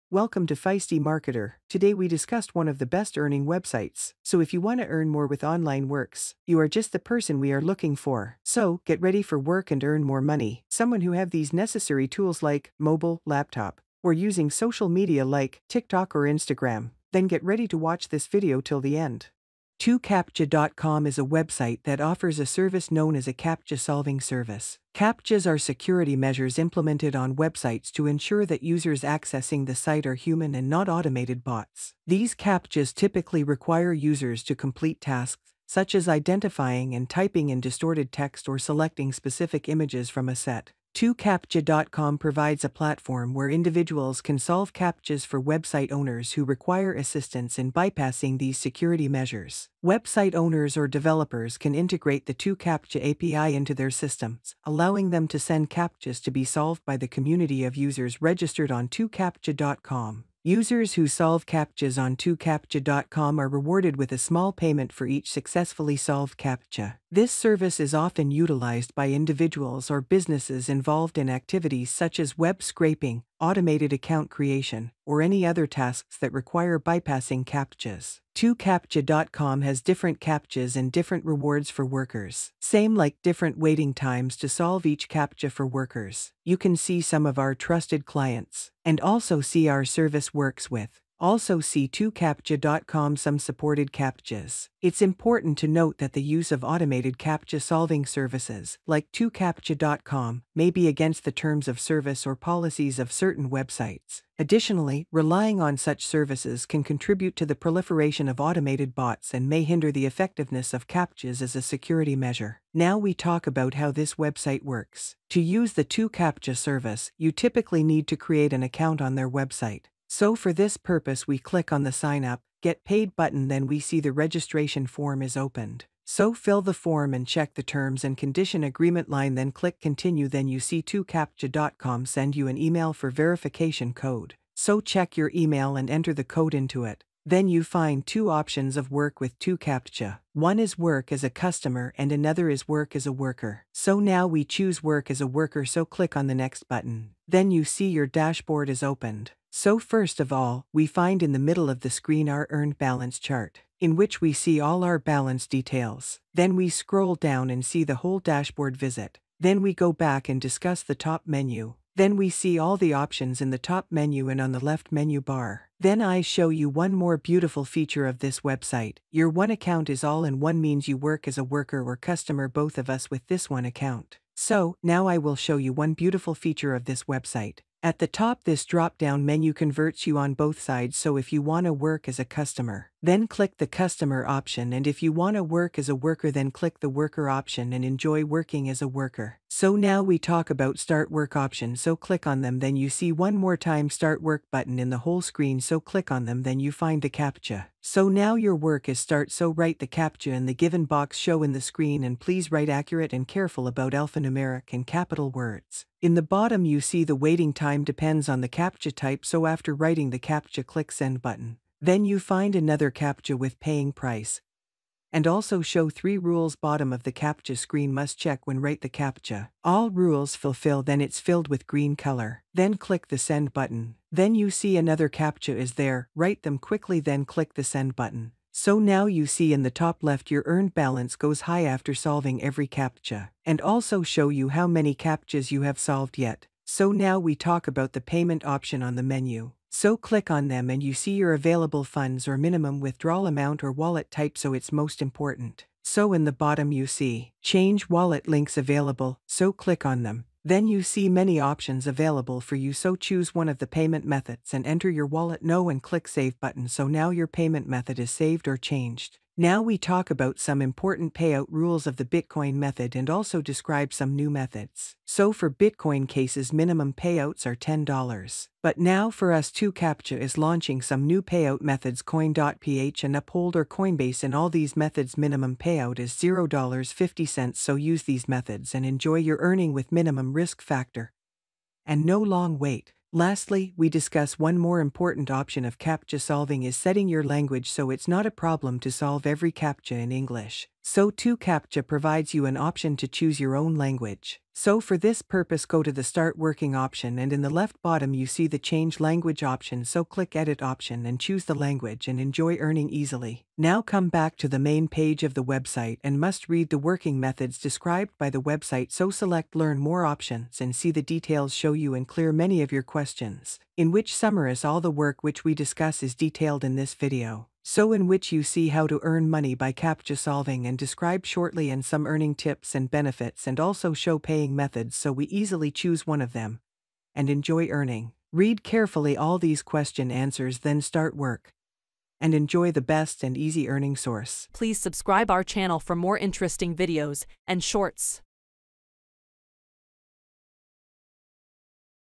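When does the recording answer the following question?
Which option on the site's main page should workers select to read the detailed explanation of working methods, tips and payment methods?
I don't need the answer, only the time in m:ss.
5:09.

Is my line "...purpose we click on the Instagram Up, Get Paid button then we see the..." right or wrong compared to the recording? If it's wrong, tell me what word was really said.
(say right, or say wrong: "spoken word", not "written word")
wrong: "Sign", not "Instagram".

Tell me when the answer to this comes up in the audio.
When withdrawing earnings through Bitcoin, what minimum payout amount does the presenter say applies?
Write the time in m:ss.
4:27.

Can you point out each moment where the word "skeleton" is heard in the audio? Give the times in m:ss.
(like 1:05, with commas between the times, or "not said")
not said.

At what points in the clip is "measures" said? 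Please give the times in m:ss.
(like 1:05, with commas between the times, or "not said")
0:26, 0:49, 1:52.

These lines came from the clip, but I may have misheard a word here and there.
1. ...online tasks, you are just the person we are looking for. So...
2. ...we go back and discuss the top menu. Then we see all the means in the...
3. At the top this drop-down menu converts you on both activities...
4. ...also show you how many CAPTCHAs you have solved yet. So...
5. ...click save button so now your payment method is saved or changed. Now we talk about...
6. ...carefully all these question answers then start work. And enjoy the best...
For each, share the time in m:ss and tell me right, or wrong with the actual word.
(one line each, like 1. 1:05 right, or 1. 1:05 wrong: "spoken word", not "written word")
1. 0:05 wrong: "works", not "tasks"
2. 2:39 wrong: "options", not "means"
3. 2:57 wrong: "sides", not "activities"
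4. 3:53 right
5. 4:15 right
6. 5:28 right.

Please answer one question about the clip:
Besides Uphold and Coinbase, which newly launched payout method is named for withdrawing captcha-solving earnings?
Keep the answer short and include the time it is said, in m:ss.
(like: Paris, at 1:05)
coin.ph, at 4:32.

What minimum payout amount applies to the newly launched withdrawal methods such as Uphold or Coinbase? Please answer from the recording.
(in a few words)
$0.50.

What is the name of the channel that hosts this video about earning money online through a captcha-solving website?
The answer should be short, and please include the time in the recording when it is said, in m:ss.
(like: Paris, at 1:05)
Feisty Marketer, at 0:00.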